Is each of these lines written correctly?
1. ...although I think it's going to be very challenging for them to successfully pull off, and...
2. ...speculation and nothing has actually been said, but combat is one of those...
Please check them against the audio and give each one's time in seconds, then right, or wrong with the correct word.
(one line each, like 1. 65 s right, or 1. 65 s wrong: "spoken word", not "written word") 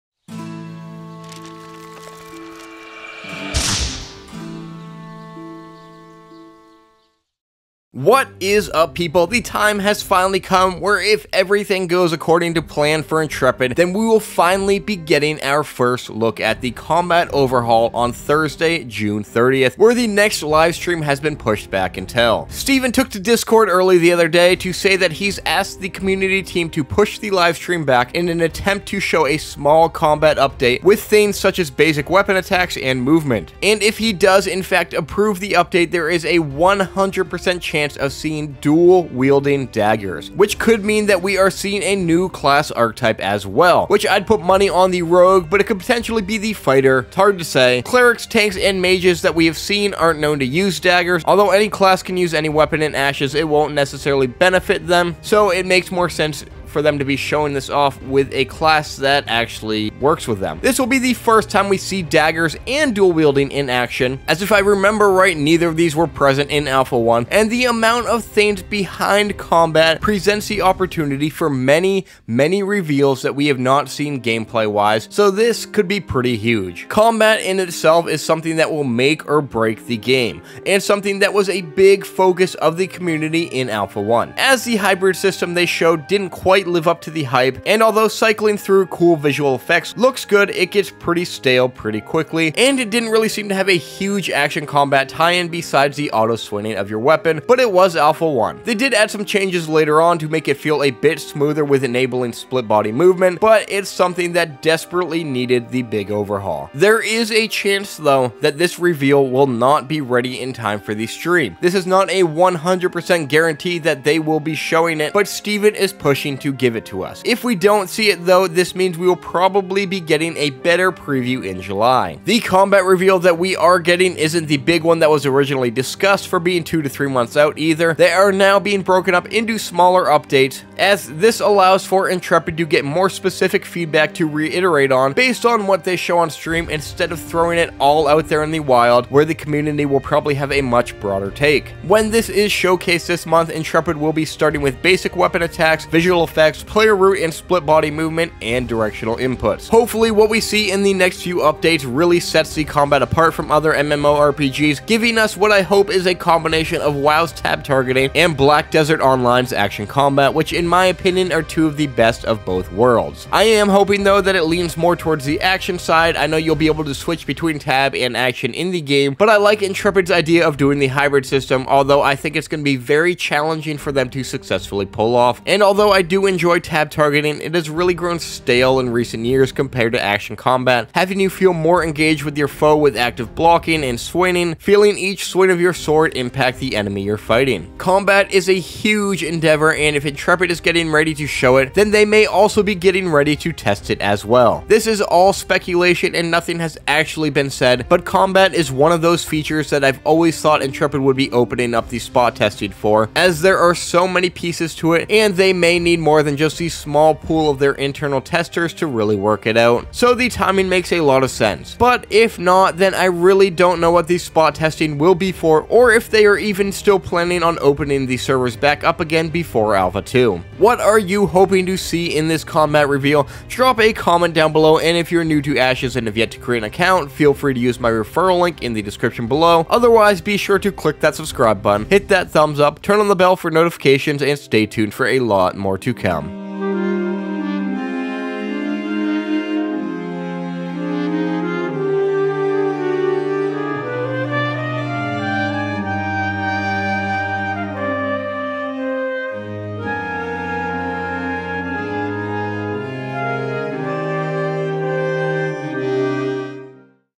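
1. 171 s right
2. 195 s right.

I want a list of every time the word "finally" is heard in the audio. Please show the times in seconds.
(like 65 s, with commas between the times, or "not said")
10 s, 14 s.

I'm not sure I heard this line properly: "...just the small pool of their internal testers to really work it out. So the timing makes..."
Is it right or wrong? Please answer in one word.
right.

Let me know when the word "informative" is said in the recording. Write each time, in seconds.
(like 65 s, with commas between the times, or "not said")
not said.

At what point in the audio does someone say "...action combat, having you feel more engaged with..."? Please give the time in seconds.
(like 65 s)
180 s.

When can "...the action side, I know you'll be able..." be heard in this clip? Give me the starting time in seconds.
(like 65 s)
165 s.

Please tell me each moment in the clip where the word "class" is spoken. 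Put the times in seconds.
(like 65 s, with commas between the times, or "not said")
42 s, 51 s, 58 s.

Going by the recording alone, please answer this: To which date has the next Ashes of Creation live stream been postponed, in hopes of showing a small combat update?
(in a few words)
Thursday, June 30th.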